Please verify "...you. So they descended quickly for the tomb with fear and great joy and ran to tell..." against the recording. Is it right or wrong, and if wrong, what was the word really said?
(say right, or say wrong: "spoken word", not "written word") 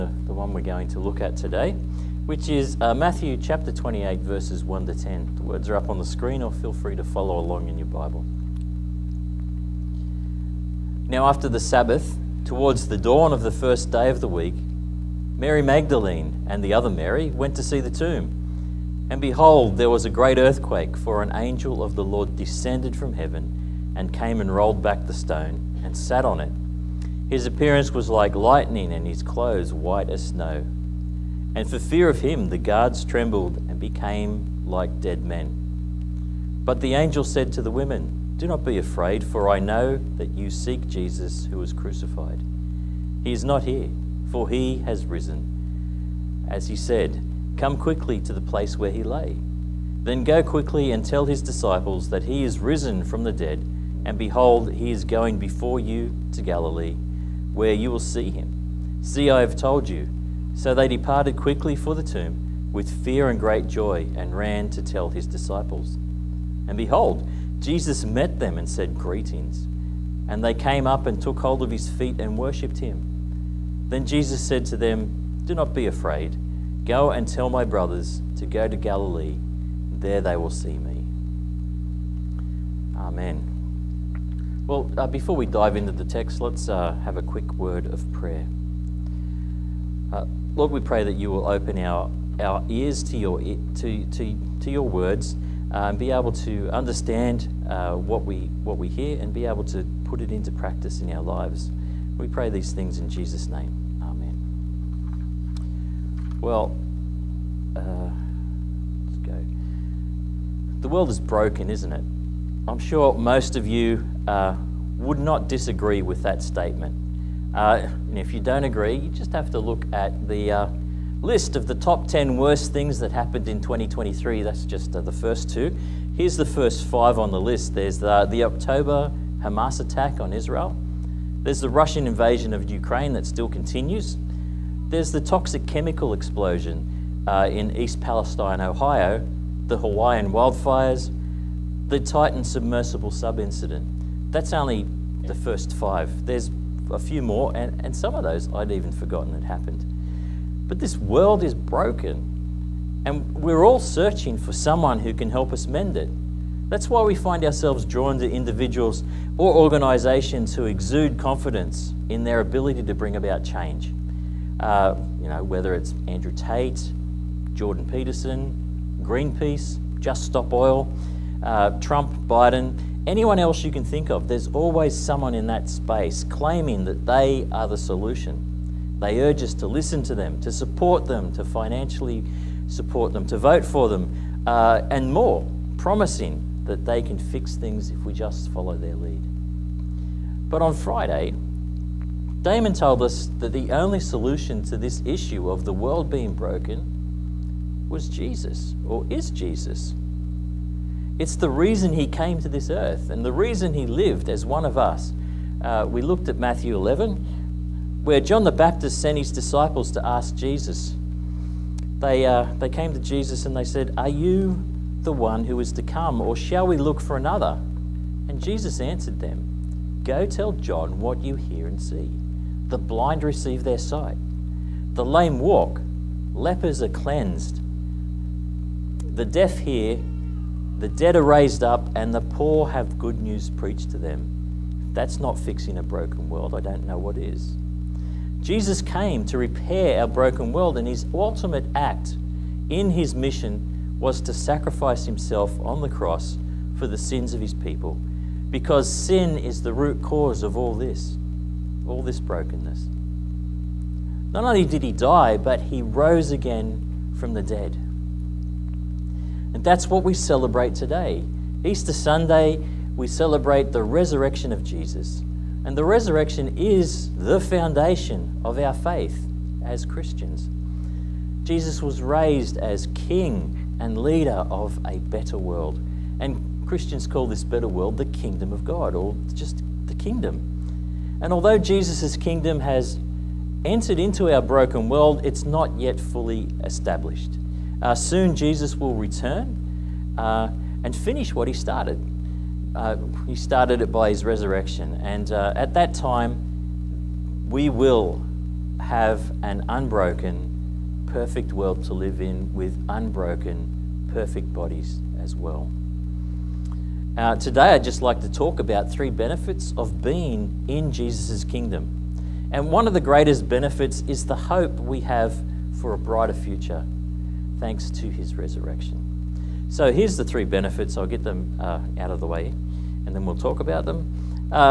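wrong: "departed", not "descended".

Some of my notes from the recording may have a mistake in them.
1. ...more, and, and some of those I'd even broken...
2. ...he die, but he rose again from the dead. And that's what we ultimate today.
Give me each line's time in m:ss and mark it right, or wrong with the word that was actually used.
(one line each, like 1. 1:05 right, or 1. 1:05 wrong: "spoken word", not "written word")
1. 2:27 wrong: "forgotten", not "broken"
2. 4:14 wrong: "celebrate", not "ultimate".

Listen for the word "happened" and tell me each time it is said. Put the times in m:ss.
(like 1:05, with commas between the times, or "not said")
2:03, 2:29.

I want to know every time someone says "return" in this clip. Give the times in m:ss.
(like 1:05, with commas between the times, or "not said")
4:48.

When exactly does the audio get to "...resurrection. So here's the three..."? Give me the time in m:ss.
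5:18.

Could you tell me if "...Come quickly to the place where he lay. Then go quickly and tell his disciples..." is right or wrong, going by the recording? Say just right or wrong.
right.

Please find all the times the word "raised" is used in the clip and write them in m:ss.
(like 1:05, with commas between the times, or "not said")
3:51, 4:32.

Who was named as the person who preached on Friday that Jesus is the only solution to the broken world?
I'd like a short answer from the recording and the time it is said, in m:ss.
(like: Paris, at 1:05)
Damon, at 3:12.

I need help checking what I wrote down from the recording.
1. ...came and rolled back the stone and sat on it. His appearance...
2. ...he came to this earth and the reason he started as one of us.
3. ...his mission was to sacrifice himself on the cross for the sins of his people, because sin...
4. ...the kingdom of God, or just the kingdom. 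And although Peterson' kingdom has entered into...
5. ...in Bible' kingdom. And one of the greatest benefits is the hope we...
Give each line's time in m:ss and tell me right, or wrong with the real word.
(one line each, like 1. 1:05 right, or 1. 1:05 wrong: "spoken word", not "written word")
1. 0:24 right
2. 3:21 wrong: "lived", not "started"
3. 4:02 right
4. 4:37 wrong: "Jesus", not "Peterson"
5. 5:10 wrong: "Jesus", not "Bible".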